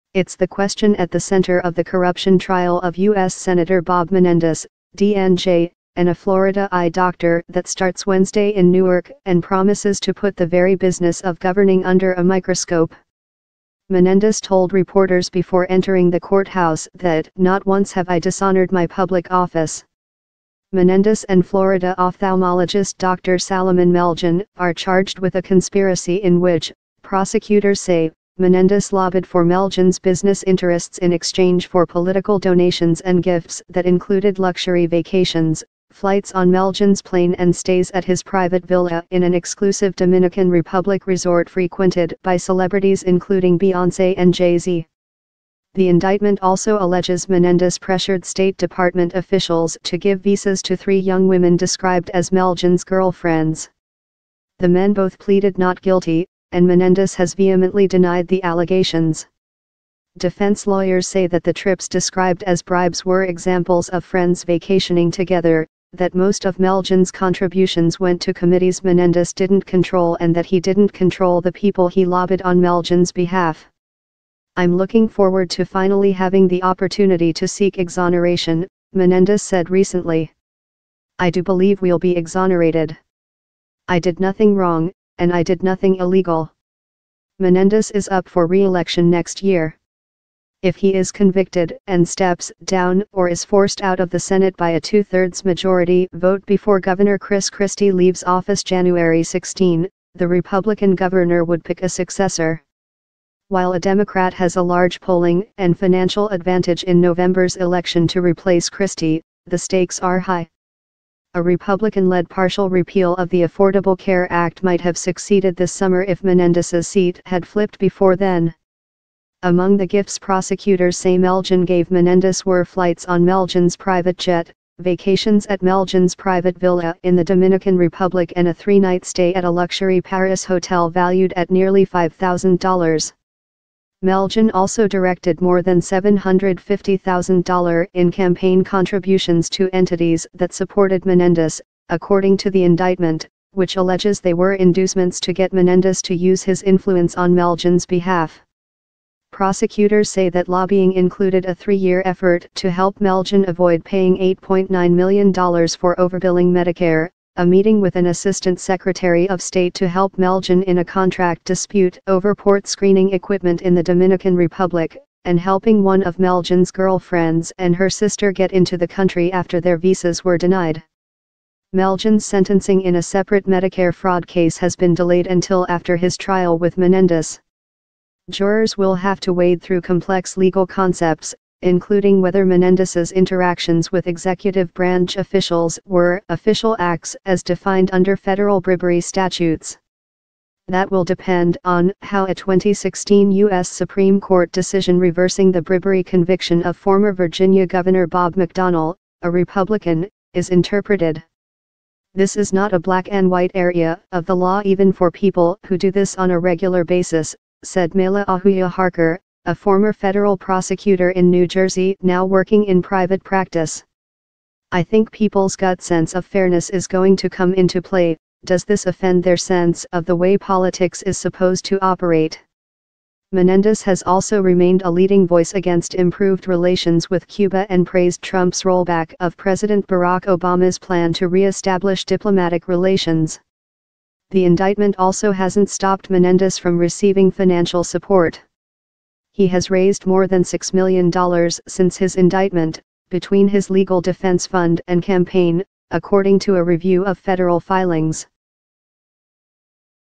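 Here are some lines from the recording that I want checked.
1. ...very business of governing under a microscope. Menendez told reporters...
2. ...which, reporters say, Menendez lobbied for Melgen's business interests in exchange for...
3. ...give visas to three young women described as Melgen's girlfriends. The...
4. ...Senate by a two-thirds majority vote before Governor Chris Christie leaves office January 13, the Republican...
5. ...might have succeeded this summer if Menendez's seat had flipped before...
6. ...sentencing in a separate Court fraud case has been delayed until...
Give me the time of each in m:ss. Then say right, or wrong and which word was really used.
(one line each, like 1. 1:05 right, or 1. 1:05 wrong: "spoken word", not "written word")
1. 0:10 right
2. 0:26 wrong: "prosecutors", not "reporters"
3. 0:49 right
4. 1:34 wrong: "16", not "13"
5. 1:54 right
6. 2:52 wrong: "Medicare", not "Court".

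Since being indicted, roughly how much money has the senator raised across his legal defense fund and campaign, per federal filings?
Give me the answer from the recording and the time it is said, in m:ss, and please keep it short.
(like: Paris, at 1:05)
more than $6 million, at 4:00.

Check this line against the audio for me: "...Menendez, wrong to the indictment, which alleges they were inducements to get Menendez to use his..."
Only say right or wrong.
wrong.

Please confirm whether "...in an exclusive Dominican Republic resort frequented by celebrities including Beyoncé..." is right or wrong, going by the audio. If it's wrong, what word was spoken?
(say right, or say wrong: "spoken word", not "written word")
right.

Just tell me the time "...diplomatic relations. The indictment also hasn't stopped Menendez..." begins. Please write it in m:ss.
3:52.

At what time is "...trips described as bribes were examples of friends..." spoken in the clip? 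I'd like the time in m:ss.
1:01.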